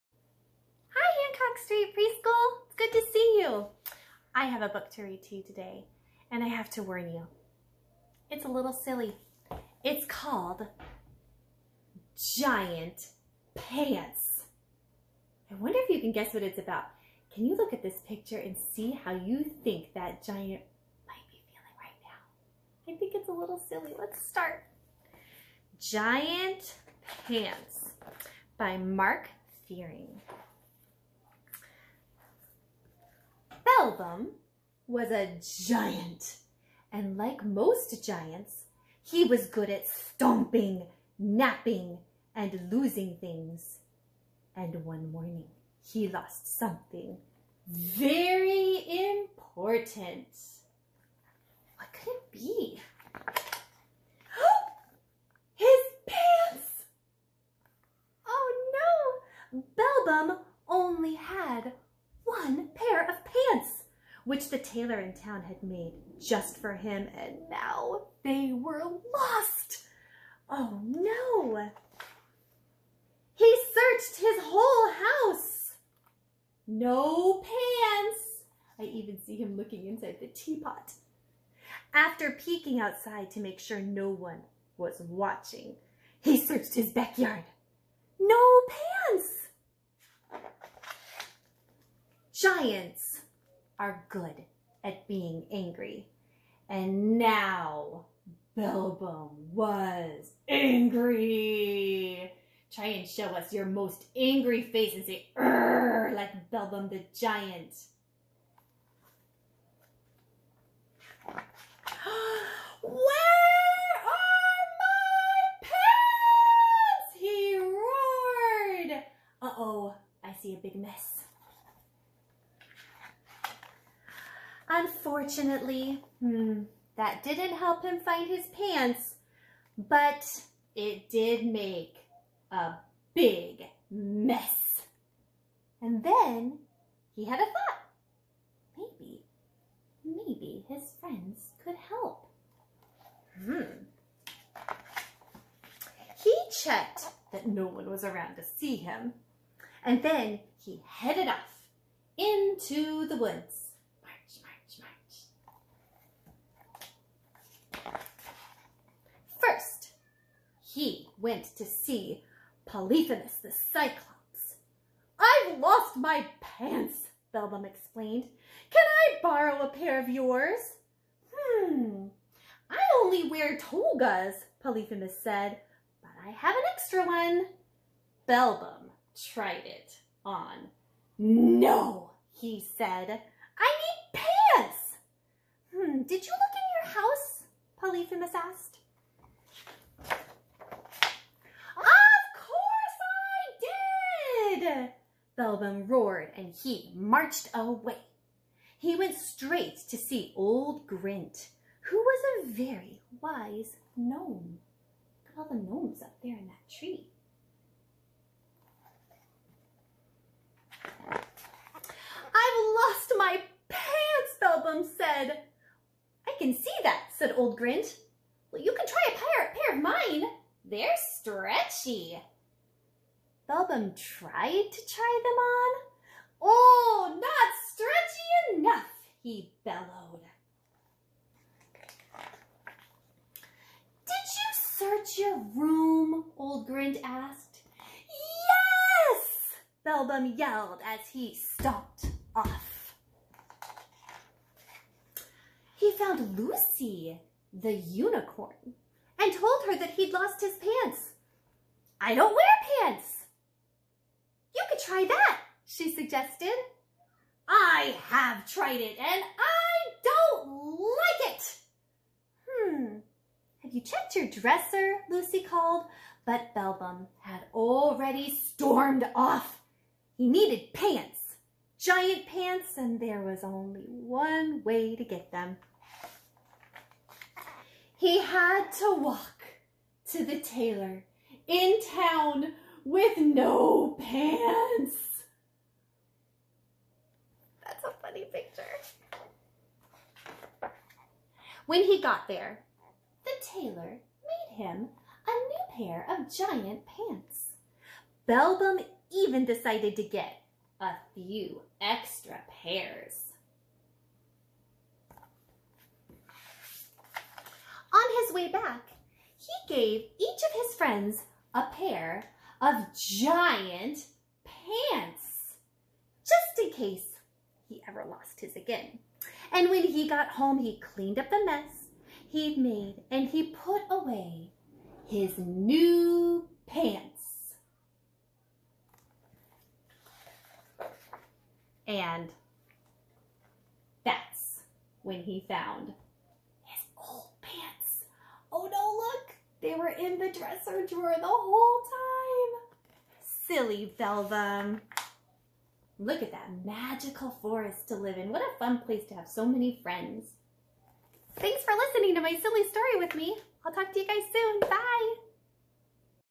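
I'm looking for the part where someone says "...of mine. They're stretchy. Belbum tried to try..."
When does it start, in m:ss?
3:39.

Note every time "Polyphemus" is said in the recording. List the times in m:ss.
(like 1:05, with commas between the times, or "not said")
2:42, 2:54, 3:07.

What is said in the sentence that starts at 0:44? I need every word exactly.
And one morning, he lost something very important.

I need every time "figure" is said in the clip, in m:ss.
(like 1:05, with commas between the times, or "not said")
not said.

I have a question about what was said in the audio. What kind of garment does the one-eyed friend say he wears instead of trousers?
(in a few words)
Togas.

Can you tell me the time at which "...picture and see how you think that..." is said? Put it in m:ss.
0:18.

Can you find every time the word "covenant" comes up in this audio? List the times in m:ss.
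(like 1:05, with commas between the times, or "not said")
not said.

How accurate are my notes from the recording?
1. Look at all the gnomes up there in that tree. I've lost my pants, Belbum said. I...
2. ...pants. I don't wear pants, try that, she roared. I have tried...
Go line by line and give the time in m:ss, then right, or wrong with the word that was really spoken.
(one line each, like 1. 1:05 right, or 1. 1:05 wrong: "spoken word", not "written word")
1. 3:25 right
2. 4:10 wrong: "suggested", not "roared".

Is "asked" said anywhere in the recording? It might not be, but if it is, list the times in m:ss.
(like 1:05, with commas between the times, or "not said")
3:08, 3:57.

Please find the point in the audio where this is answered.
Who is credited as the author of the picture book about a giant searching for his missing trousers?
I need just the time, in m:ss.
0:28.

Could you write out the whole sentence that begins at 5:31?
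And that's when he found his old pants.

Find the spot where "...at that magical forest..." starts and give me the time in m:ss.
5:46.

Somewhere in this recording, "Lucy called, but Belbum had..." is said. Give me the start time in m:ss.
4:25.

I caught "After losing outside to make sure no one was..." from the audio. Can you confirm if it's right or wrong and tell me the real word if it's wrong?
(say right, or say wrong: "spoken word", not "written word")
wrong: "peeking", not "losing".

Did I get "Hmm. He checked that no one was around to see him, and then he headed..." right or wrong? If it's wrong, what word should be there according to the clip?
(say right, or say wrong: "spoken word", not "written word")
right.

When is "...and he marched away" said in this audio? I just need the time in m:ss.
3:16.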